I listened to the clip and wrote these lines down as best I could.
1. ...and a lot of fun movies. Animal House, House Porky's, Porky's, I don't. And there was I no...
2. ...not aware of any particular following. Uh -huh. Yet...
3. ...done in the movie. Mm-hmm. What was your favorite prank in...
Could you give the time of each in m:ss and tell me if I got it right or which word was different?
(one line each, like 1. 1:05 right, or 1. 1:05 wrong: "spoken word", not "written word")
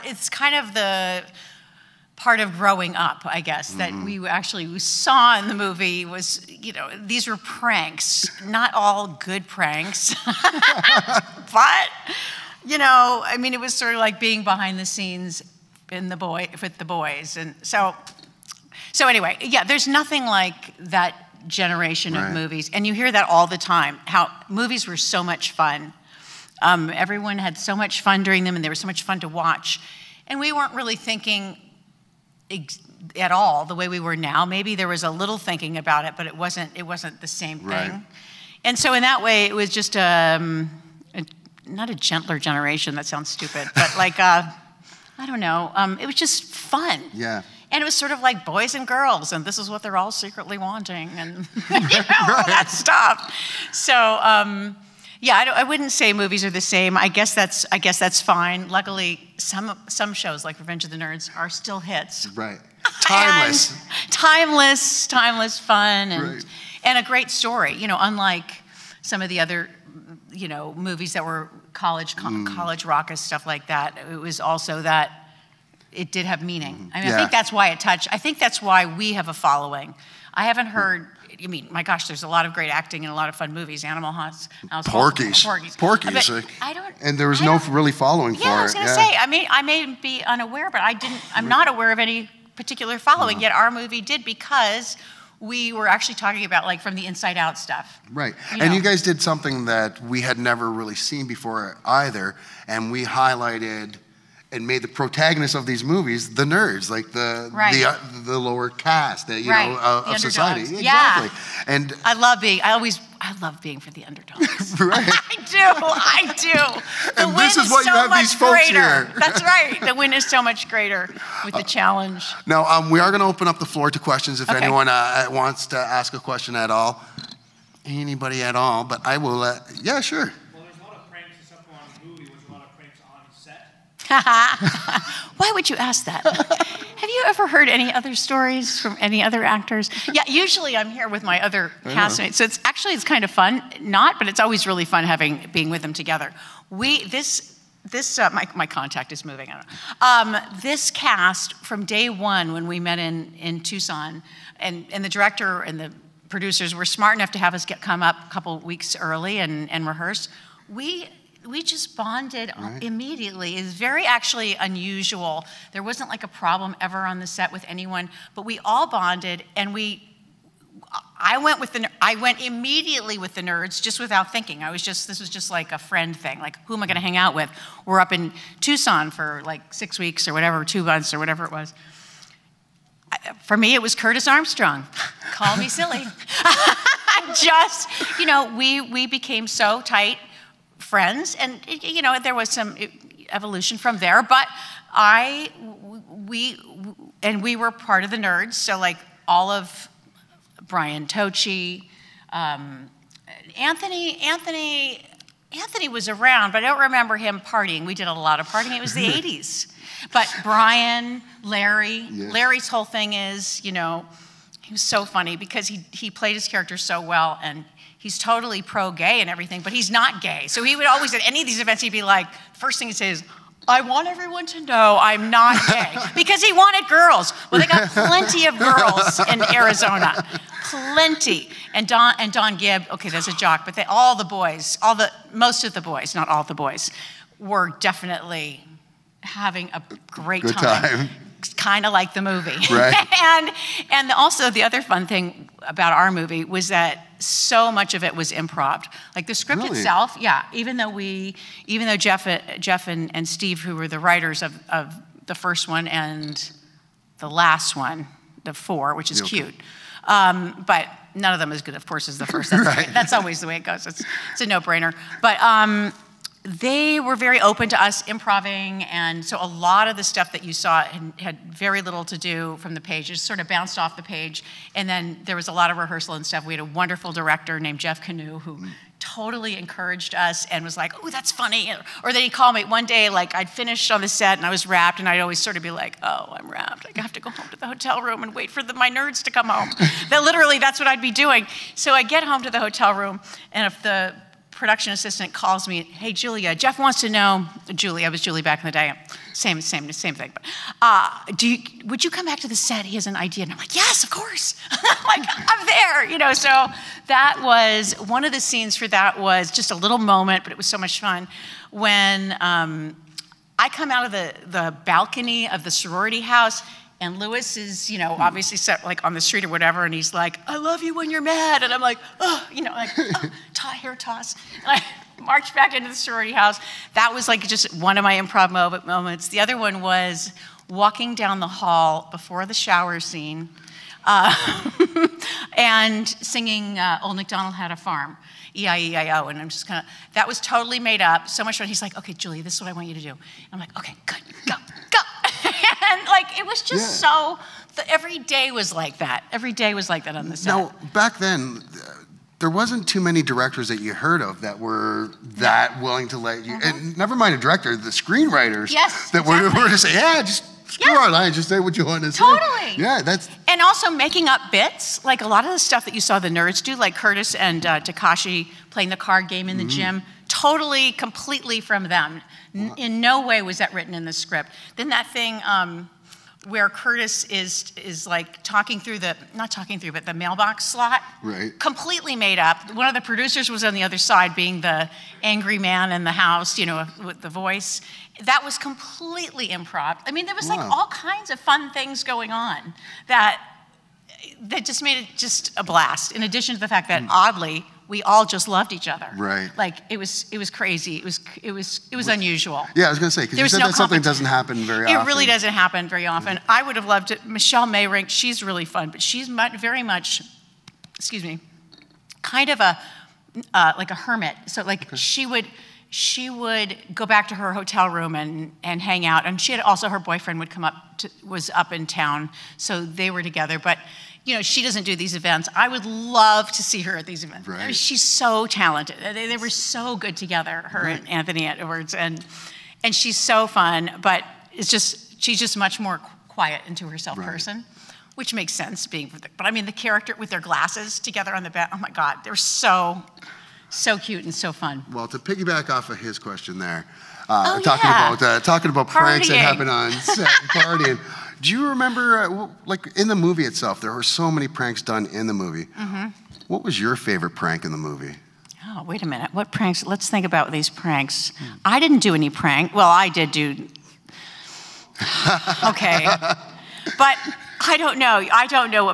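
1. 1:23 right
2. 1:31 right
3. 7:34 right.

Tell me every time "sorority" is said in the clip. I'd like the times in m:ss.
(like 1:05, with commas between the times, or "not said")
5:15, 5:25.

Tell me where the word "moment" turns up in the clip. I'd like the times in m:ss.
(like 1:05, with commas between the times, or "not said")
5:09, 5:28.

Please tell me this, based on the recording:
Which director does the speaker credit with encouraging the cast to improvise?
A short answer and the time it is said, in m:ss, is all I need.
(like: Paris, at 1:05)
Jeff Kanew, at 4:37.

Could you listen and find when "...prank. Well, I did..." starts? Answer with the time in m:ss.
7:42.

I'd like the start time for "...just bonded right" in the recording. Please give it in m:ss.
2:41.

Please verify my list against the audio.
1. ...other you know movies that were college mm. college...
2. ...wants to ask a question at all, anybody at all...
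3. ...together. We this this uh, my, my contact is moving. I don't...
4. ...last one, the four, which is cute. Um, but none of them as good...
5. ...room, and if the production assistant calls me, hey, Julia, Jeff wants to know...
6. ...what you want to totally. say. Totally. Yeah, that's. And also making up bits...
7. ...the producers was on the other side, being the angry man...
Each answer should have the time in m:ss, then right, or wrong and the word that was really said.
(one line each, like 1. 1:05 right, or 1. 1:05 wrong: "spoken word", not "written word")
1. 1:09 right
2. 2:05 right
3. 2:25 right
4. 4:17 right
5. 4:52 right
6. 6:01 right
7. 6:22 right.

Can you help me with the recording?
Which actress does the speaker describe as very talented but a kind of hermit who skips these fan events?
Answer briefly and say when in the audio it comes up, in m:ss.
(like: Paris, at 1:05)
Michelle Meyrink, at 6:47.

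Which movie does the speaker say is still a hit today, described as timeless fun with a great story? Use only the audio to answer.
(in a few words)
Revenge of the Nerds.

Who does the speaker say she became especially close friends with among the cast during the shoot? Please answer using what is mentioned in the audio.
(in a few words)
Curtis Armstrong.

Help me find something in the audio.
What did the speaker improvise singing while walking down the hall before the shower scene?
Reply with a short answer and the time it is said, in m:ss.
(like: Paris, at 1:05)
Old MacDonald Had a Farm, at 5:37.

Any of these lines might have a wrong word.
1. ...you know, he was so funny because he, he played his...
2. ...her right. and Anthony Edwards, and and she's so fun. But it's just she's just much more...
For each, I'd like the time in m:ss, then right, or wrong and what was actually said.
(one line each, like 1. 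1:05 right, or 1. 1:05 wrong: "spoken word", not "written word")
1. 3:33 right
2. 7:10 right.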